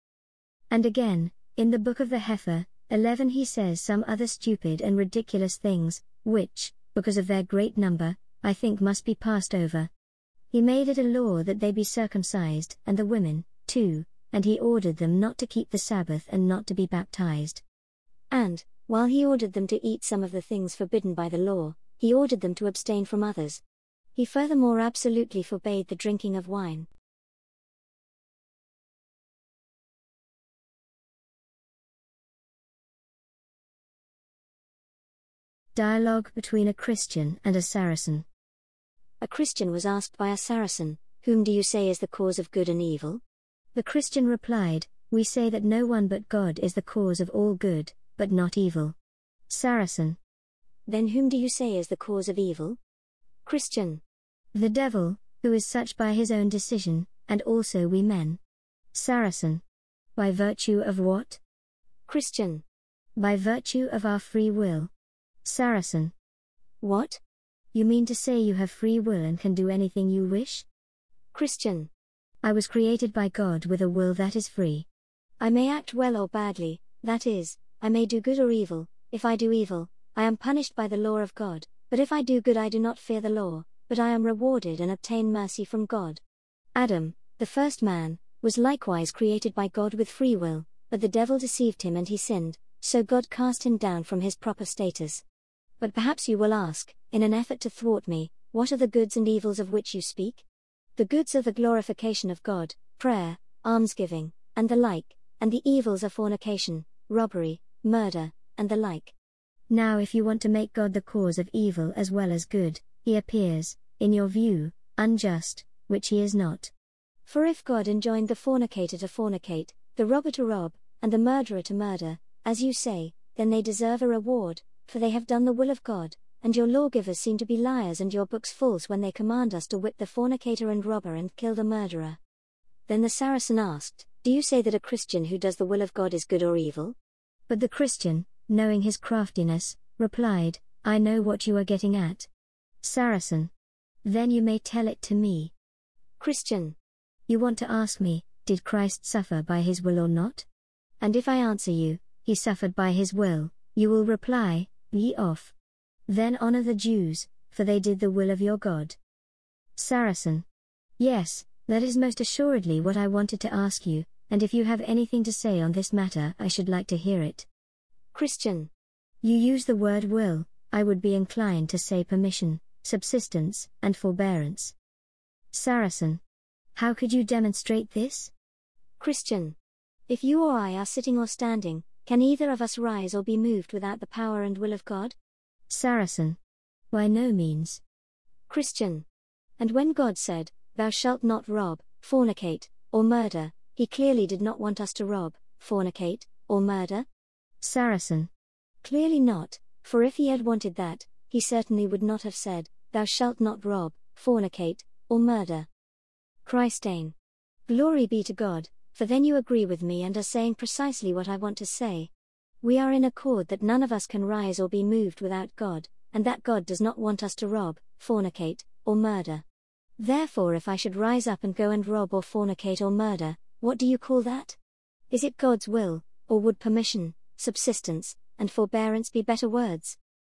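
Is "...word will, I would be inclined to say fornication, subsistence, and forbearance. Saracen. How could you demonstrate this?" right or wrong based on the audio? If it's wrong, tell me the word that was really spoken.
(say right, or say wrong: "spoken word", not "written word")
wrong: "permission", not "fornication".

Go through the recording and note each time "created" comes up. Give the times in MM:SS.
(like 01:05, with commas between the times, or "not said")
01:12, 01:29.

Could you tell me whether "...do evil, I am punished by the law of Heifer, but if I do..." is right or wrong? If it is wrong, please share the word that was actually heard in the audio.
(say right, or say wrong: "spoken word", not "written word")
wrong: "God", not "Heifer".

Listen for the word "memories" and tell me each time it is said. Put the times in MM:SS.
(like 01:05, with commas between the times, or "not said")
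not said.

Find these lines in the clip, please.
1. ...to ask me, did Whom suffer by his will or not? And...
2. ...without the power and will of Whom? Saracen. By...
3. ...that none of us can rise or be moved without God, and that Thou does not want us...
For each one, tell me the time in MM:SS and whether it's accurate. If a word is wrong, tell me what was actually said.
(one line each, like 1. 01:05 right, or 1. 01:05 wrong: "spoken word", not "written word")
1. 02:27 wrong: "Christ", not "Whom"
2. 03:03 wrong: "God", not "Whom"
3. 03:33 wrong: "God", not "Thou".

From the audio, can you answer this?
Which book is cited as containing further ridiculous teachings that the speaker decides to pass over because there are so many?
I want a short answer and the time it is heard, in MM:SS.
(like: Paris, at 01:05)
The book of the Heifer, at 00:01.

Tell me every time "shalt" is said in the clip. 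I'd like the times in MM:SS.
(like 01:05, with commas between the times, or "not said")
03:10, 03:23.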